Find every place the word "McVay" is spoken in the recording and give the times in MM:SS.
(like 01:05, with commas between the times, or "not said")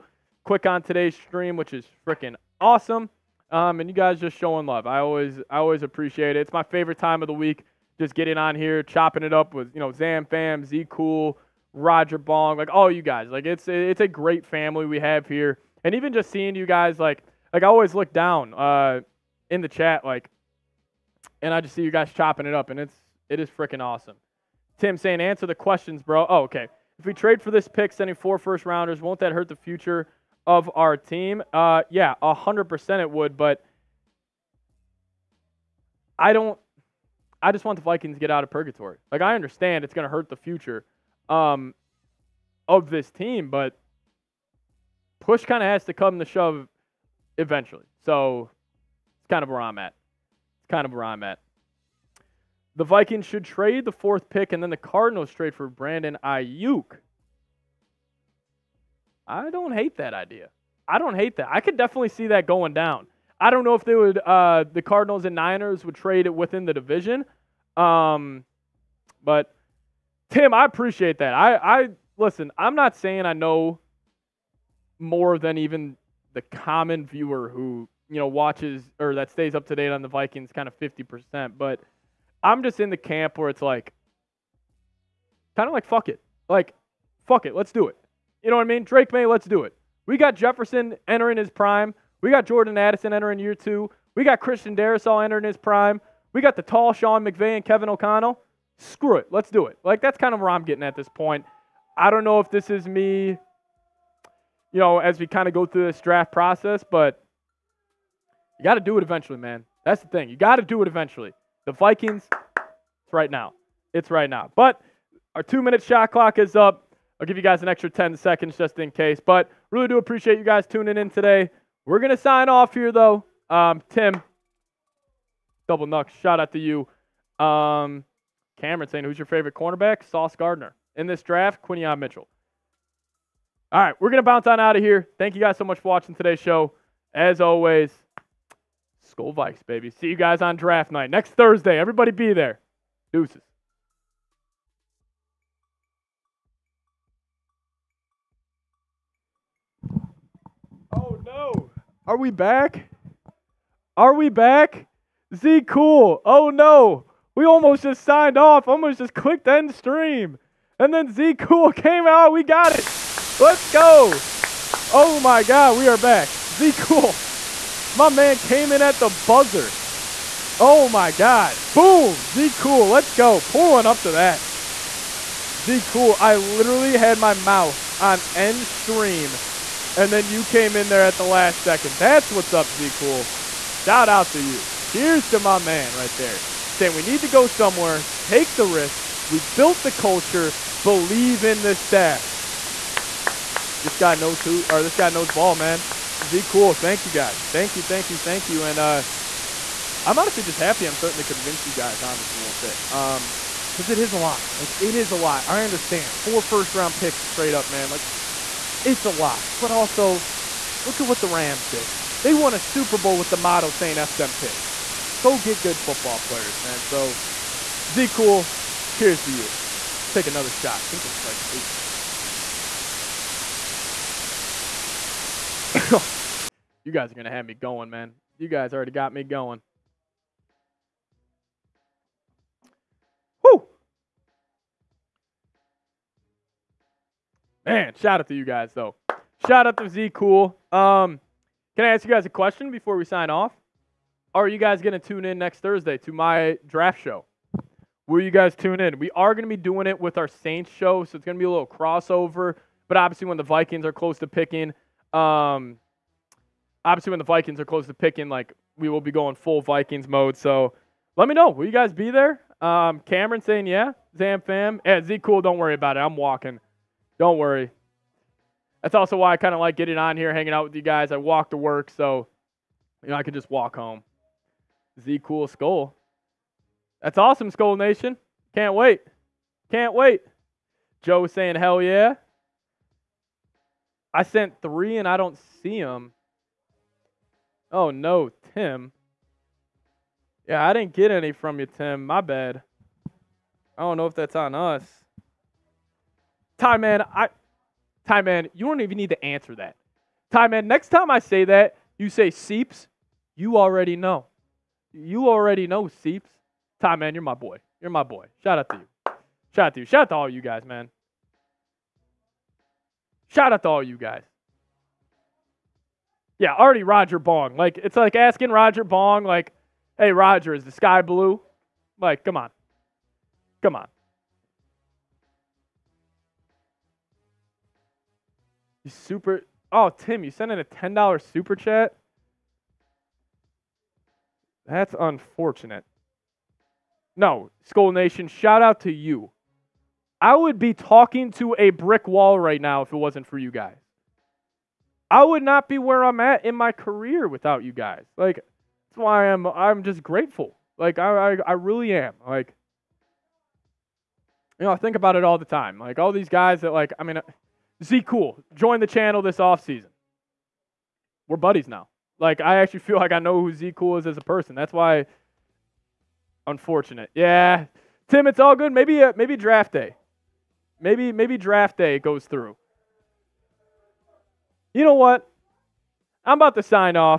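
01:37.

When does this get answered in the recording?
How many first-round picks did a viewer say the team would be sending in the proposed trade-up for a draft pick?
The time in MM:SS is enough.
00:28.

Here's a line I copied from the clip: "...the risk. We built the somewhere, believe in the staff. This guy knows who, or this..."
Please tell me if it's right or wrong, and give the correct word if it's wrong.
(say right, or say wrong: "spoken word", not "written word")
wrong: "culture", not "somewhere".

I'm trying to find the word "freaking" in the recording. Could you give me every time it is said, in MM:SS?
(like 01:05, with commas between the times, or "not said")
00:02, 00:23.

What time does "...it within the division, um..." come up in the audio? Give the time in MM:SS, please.
01:06.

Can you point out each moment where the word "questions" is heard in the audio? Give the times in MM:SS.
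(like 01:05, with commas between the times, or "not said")
00:25, 04:02.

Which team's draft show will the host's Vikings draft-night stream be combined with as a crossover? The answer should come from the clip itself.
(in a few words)
Saints.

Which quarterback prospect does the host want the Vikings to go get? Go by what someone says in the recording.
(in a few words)
Drake Maye.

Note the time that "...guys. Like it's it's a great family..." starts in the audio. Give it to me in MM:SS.
00:13.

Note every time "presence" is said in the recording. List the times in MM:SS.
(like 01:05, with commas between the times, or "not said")
not said.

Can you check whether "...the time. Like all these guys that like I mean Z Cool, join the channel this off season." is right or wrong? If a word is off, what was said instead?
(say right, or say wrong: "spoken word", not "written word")
right.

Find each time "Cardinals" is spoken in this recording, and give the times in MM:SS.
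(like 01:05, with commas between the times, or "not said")
00:54, 01:04.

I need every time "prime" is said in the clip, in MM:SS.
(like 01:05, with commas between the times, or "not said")
01:31, 01:35.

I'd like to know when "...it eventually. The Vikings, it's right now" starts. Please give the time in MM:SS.
01:50.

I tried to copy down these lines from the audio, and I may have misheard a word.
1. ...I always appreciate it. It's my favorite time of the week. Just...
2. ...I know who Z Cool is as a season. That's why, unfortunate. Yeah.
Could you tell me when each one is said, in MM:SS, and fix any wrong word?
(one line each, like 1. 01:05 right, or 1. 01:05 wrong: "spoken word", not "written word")
1. 00:05 right
2. 06:03 wrong: "person", not "season".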